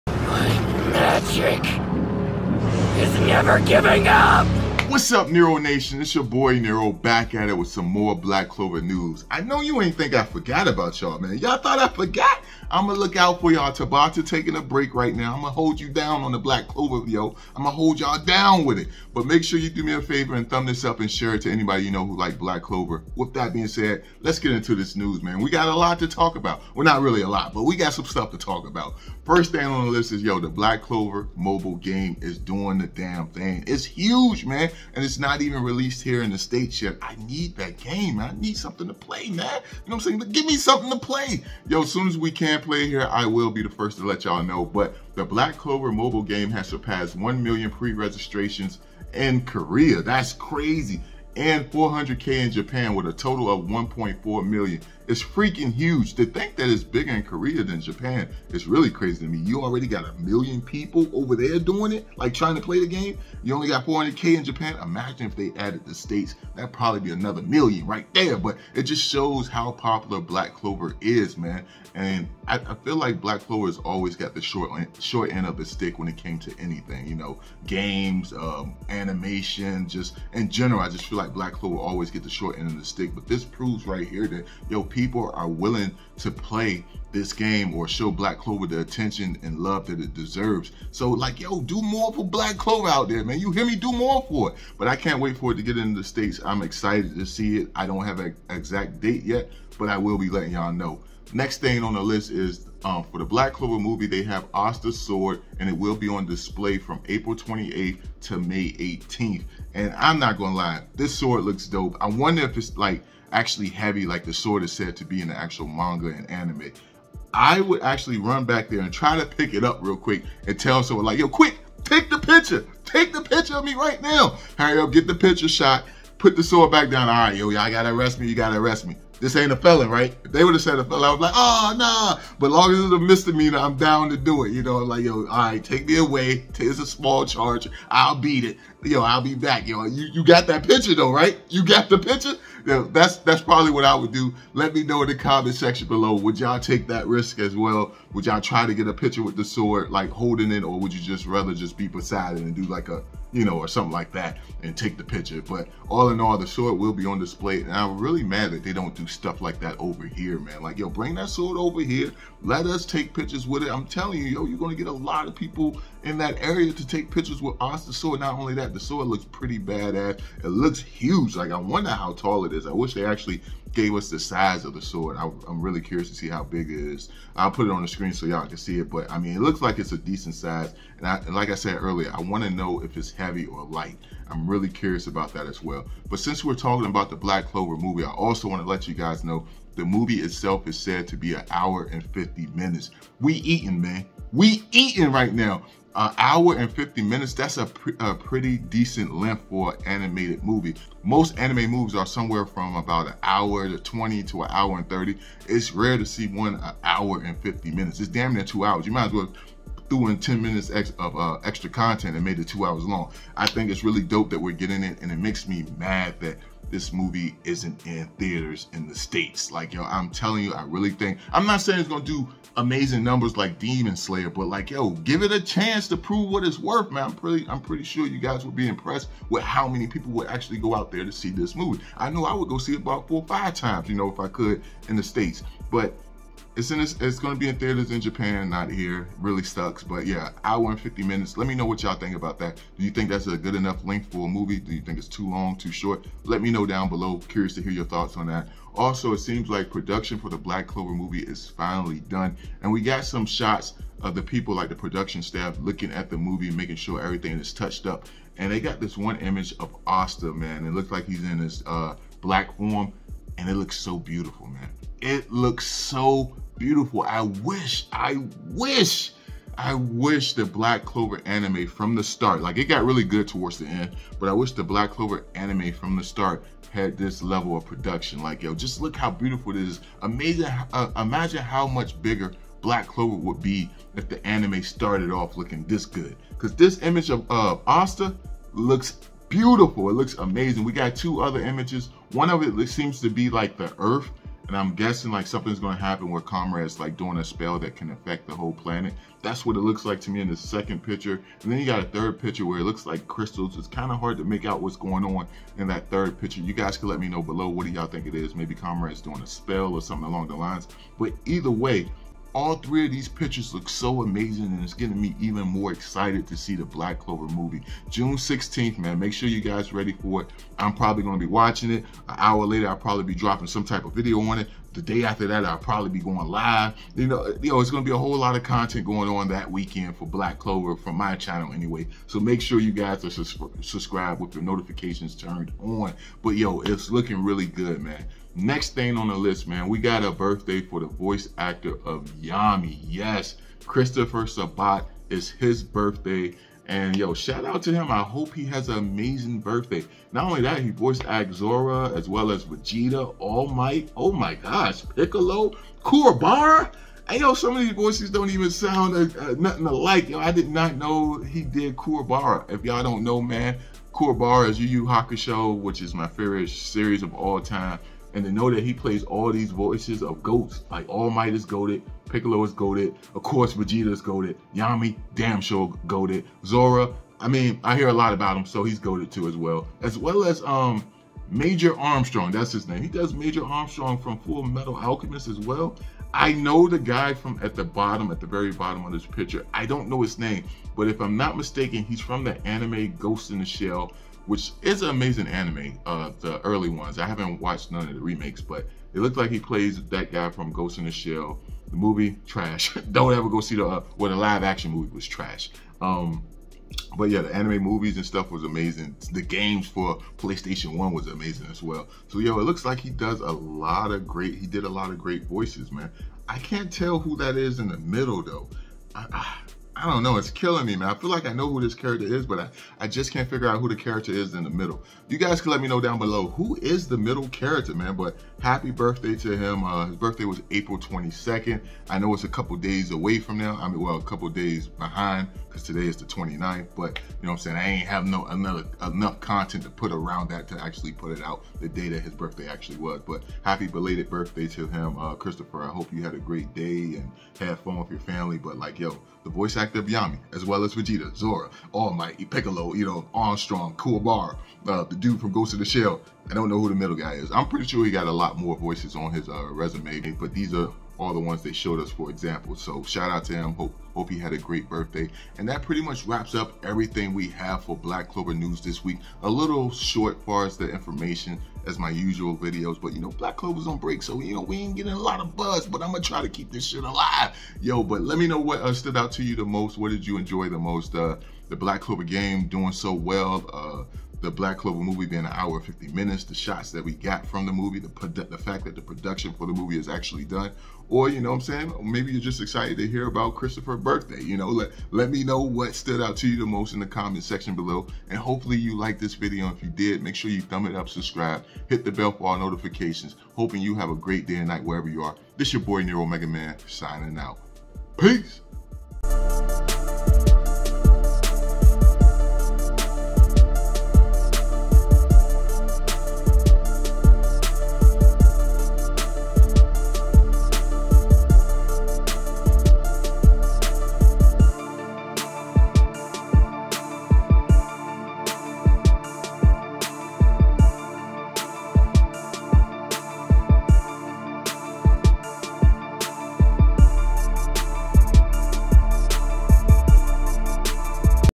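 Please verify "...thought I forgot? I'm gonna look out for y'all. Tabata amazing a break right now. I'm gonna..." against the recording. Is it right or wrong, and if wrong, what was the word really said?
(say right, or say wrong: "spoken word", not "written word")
wrong: "taking", not "amazing".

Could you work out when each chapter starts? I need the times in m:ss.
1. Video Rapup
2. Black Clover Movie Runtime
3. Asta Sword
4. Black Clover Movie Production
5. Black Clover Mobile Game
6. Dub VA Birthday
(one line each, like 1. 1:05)
1. 7:47
2. 3:12
3. 1:45
4. 4:11
5. 0:46
6. 5:42.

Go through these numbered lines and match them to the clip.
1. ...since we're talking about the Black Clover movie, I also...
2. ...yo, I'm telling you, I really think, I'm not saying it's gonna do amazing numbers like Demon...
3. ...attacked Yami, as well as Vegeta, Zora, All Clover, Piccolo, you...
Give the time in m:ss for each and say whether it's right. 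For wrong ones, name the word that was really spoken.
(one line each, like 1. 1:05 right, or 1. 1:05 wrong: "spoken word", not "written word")
1. 3:06 right
2. 3:39 right
3. 7:29 wrong: "Might", not "Clover".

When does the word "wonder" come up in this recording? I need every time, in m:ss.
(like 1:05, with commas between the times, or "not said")
1:52, 2:51.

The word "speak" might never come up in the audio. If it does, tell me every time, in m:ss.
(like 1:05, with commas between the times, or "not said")
not said.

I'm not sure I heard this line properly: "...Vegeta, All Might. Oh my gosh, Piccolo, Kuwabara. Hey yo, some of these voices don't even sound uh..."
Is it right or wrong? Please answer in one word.
right.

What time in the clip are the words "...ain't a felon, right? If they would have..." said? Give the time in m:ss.
2:09.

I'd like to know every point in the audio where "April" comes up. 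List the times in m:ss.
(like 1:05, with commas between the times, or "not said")
1:47, 7:10.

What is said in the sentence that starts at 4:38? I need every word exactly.
Like, yo, just look how beautiful it is.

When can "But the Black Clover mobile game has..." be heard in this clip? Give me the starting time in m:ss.
0:44.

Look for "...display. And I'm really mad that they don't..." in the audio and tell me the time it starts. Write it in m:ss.
2:37.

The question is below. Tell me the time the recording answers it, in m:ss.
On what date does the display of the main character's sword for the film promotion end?
1:48.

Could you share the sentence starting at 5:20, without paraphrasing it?
I'm probably gonna be watching it.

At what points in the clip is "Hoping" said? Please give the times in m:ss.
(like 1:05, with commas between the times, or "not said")
8:23.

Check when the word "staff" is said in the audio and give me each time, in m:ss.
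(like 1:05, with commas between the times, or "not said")
4:15.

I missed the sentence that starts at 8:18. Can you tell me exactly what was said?
And hopefully you liked this video.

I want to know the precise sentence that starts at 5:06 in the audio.
You guys could let me know below what do y'all think it is.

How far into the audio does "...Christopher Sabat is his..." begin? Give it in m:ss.
5:43.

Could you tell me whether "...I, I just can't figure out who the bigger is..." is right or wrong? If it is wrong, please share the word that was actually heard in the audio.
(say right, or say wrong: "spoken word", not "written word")
wrong: "character", not "bigger".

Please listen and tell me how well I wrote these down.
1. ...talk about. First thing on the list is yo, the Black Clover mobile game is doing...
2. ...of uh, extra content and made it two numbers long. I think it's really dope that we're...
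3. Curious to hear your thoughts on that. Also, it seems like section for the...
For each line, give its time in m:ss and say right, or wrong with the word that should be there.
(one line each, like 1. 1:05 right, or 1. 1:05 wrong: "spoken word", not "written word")
1. 0:28 right
2. 3:30 wrong: "hours", not "numbers"
3. 4:07 wrong: "production", not "section".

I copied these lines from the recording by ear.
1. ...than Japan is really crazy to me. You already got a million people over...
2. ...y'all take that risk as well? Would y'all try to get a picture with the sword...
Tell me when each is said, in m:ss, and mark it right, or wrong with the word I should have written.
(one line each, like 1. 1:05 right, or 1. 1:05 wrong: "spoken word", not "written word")
1. 0:57 right
2. 2:26 right.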